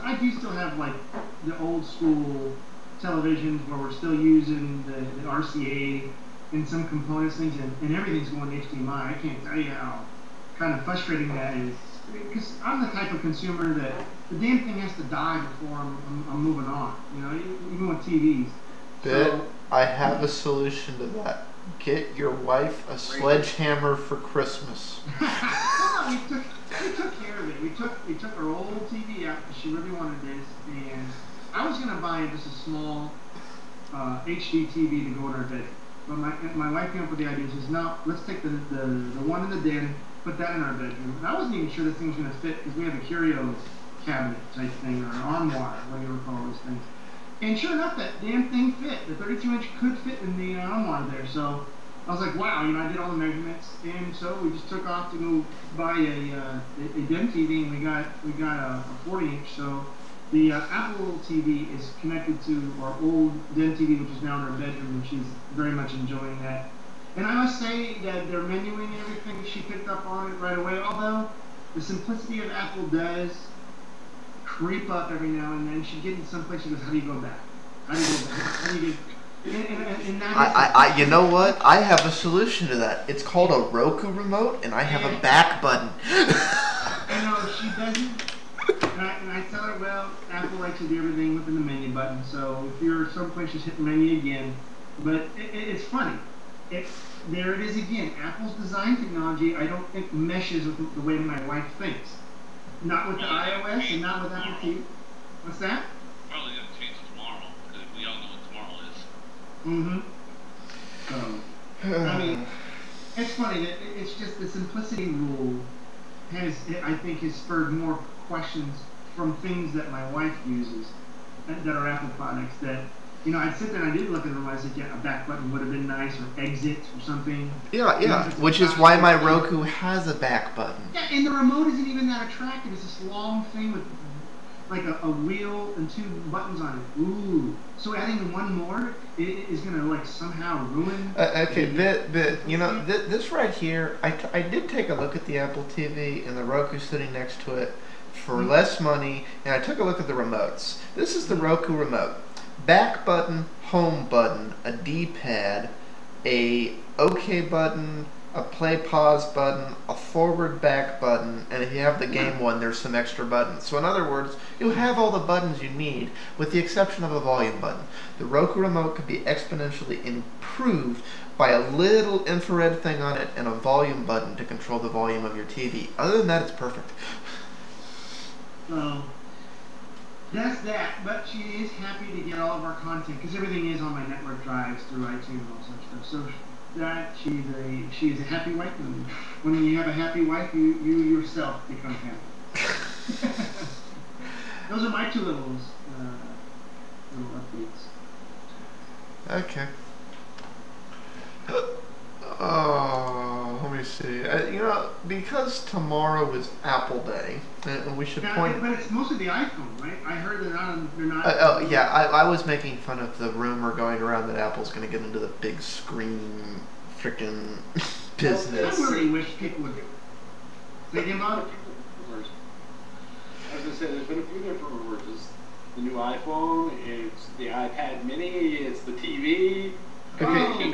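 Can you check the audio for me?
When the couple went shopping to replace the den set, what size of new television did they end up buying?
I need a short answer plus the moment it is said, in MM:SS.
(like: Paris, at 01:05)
40 inch, at 00:58.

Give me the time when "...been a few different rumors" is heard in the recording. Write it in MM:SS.
03:44.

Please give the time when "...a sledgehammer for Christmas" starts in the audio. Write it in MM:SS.
00:22.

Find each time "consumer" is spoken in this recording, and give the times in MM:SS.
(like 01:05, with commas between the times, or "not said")
00:13.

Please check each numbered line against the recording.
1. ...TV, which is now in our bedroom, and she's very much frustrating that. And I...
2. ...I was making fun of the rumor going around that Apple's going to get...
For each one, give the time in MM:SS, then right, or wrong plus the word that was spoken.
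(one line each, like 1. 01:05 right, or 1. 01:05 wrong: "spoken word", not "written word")
1. 01:03 wrong: "enjoying", not "frustrating"
2. 03:32 right.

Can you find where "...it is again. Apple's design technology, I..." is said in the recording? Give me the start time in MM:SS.
01:37.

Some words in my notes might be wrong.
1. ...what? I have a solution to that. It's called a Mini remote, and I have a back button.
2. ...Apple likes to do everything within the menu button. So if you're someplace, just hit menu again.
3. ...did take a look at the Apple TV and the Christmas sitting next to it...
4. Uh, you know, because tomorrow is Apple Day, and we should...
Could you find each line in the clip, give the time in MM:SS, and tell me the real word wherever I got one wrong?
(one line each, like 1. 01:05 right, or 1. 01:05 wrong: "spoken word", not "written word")
1. 01:21 wrong: "Roku", not "Mini"
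2. 01:30 right
3. 02:24 wrong: "Roku", not "Christmas"
4. 03:24 right.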